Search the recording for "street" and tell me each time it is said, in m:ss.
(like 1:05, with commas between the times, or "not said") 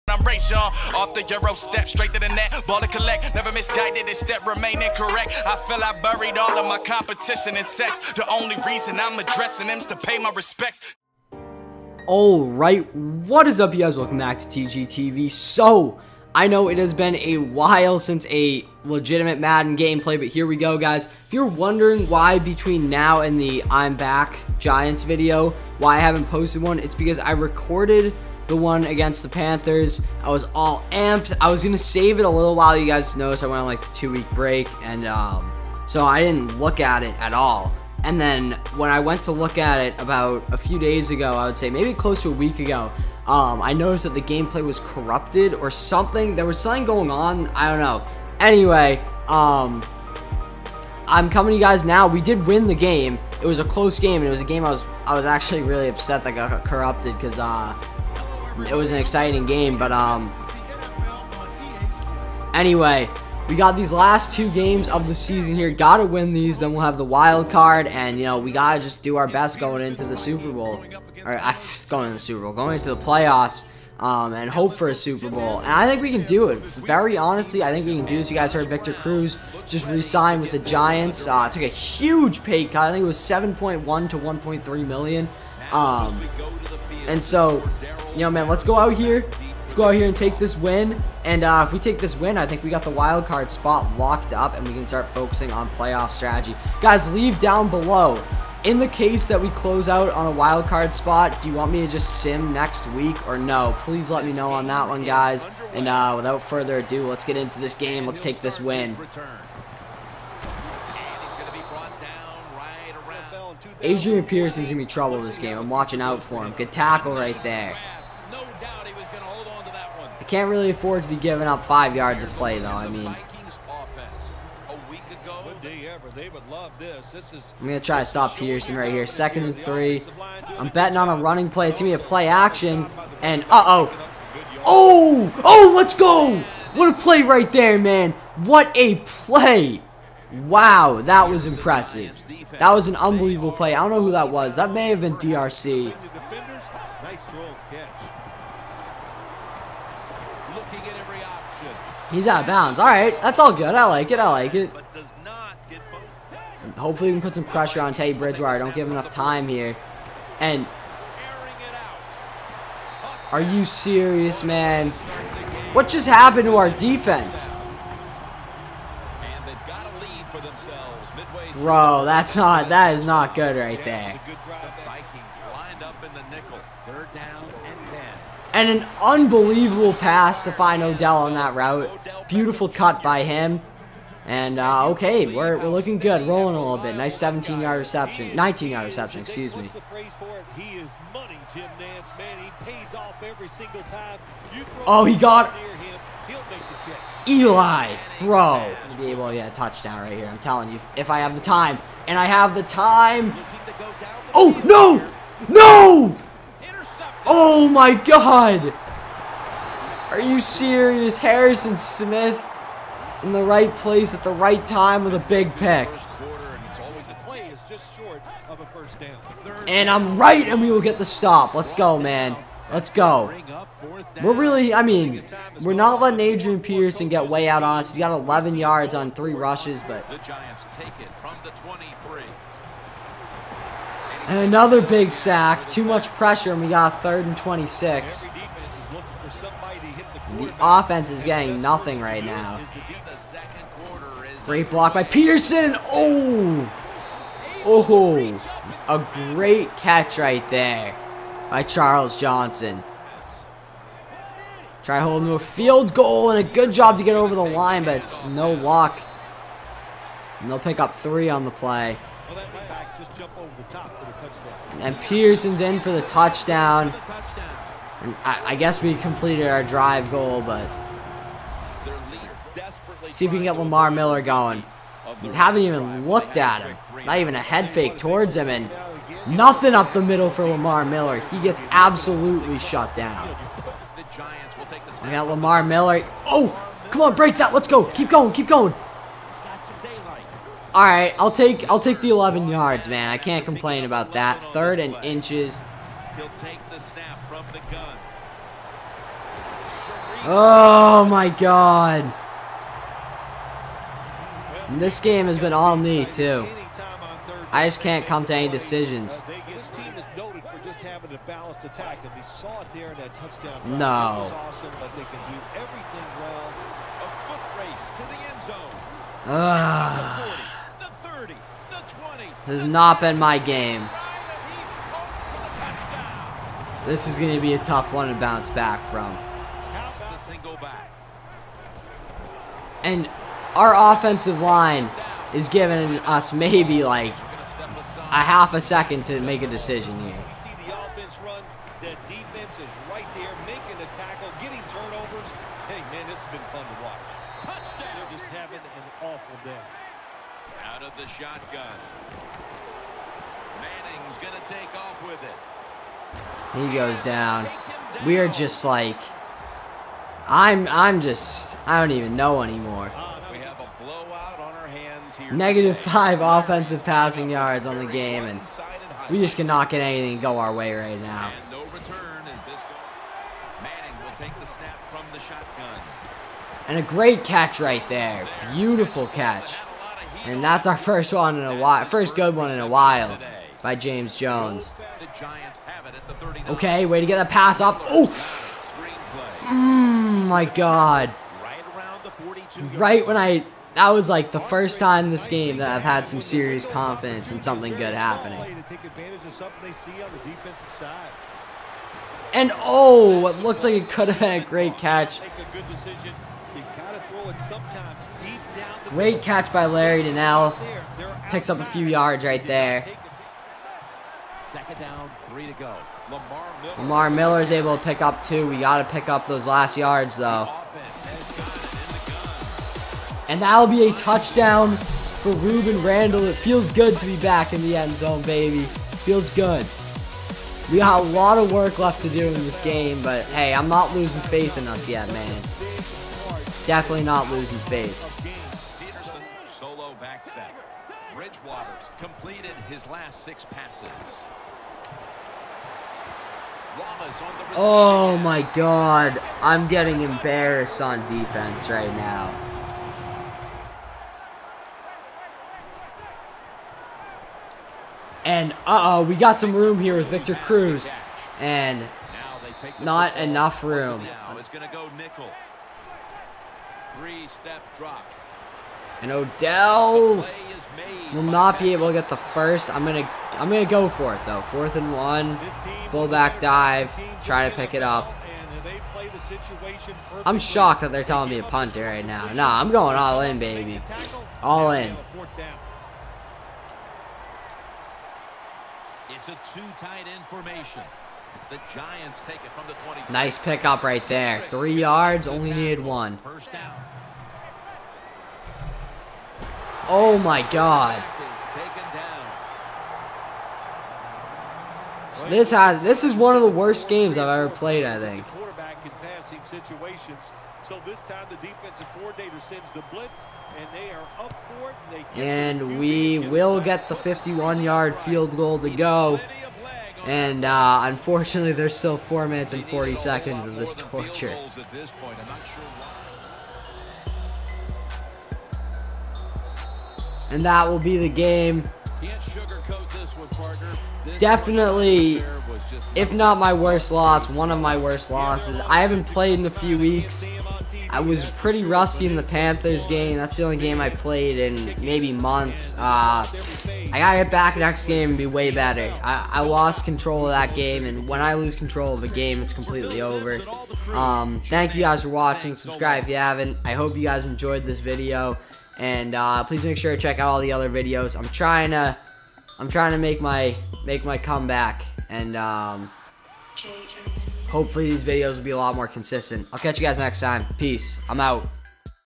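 not said.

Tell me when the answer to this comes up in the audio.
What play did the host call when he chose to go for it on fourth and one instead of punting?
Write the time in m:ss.
7:55.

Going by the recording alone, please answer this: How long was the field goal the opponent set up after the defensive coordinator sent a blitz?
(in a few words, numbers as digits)
51 yards.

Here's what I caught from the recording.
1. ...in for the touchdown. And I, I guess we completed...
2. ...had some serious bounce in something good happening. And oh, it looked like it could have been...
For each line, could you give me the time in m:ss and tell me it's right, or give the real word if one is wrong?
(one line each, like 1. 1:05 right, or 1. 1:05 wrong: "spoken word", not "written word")
1. 4:25 right
2. 6:35 wrong: "confidence", not "bounce".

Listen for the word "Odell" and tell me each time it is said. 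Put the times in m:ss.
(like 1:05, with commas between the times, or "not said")
3:00, 7:49.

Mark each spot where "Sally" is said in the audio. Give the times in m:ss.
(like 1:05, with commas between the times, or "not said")
not said.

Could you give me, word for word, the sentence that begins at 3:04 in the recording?
And, uh, okay, we're, we're looking good, rolling a little bit.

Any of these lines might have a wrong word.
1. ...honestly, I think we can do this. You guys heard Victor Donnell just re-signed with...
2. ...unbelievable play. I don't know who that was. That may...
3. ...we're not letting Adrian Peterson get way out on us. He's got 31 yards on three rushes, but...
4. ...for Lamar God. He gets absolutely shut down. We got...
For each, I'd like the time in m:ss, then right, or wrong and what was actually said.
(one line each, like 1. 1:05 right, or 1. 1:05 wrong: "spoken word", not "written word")
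1. 1:17 wrong: "Cruz", not "Donnell"
2. 2:22 right
3. 3:45 wrong: "11", not "31"
4. 4:40 wrong: "Miller", not "God".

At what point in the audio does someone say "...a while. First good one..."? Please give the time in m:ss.
6:21.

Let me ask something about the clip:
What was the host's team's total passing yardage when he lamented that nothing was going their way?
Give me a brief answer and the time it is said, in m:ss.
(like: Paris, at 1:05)
-5, at 6:05.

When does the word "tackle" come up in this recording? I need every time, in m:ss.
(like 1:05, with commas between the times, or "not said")
1:56, 5:43.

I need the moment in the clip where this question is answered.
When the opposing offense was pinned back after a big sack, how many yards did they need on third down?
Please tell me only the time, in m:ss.
3:57.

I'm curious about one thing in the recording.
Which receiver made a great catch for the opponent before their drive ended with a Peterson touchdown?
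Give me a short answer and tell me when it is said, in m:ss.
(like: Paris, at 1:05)
Charles Johnson, at 4:11.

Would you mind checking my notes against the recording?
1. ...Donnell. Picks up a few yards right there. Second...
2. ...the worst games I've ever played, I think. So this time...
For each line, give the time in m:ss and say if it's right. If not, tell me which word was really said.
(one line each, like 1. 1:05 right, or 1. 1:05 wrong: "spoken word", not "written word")
1. 6:50 right
2. 8:26 right.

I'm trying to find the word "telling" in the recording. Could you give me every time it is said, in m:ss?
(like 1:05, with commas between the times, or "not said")
3:20, 8:01.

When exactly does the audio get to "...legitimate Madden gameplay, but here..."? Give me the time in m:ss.
0:18.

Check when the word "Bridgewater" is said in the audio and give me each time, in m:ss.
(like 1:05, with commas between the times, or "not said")
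2:38, 7:21.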